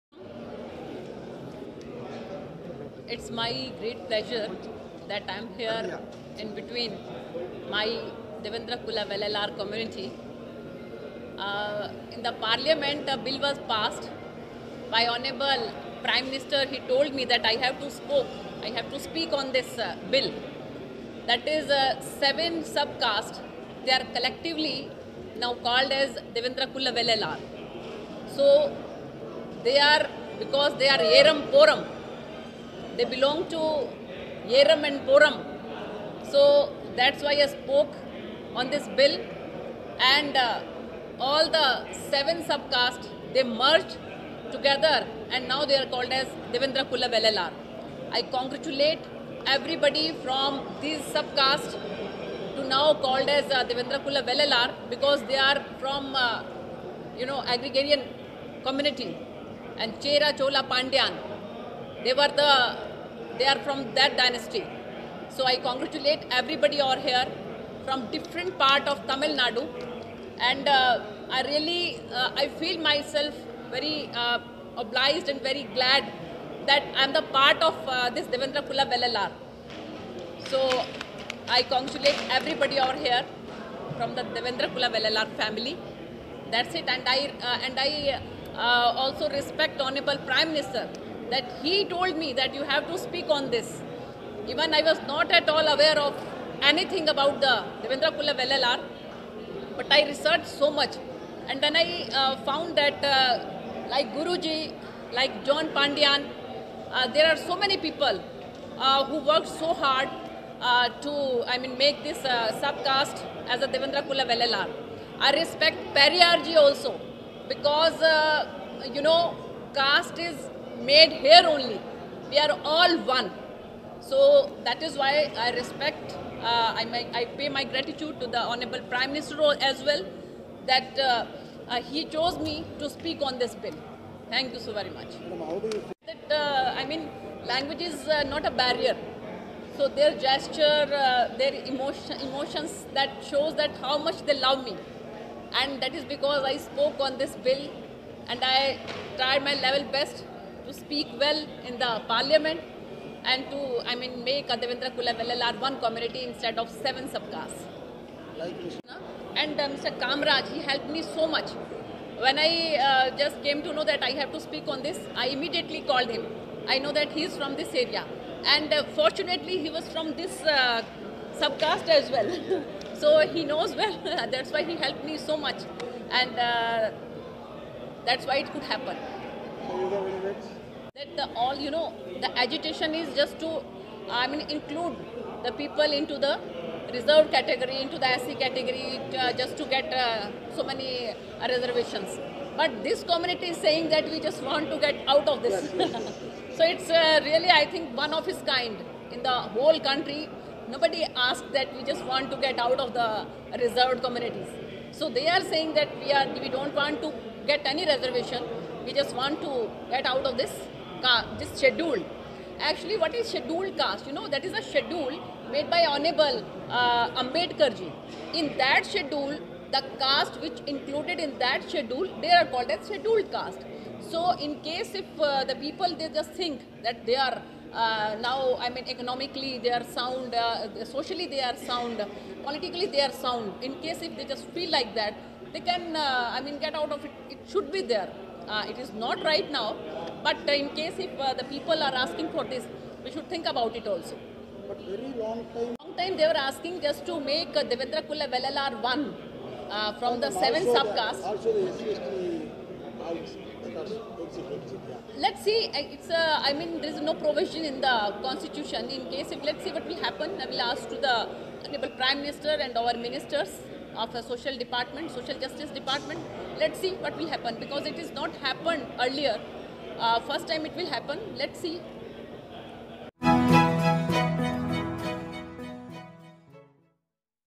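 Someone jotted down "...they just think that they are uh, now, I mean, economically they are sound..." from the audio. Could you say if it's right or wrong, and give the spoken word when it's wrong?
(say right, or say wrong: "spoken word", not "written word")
right.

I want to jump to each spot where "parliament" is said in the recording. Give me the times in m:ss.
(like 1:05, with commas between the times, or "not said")
0:12, 2:32.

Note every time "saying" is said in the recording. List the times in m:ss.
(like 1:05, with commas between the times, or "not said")
3:13, 3:25.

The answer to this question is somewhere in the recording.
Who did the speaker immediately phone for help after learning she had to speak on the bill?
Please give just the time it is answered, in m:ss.
2:39.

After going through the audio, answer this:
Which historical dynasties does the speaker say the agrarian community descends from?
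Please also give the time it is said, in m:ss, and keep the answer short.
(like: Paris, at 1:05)
Chera Chola Pandyan, at 1:00.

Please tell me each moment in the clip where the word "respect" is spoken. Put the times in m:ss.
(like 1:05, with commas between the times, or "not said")
1:29, 1:55, 2:05.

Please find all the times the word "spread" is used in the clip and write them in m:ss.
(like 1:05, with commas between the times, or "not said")
not said.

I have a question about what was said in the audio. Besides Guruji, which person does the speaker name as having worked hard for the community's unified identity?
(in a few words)
John Pandian.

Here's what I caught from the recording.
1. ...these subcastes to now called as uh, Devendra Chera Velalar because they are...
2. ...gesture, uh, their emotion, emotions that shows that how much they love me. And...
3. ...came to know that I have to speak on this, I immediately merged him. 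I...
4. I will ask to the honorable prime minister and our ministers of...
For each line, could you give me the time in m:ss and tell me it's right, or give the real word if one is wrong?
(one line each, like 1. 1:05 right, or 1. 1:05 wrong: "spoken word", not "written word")
1. 0:50 wrong: "Kula", not "Chera"
2. 2:20 right
3. 2:43 wrong: "called", not "merged"
4. 4:20 right.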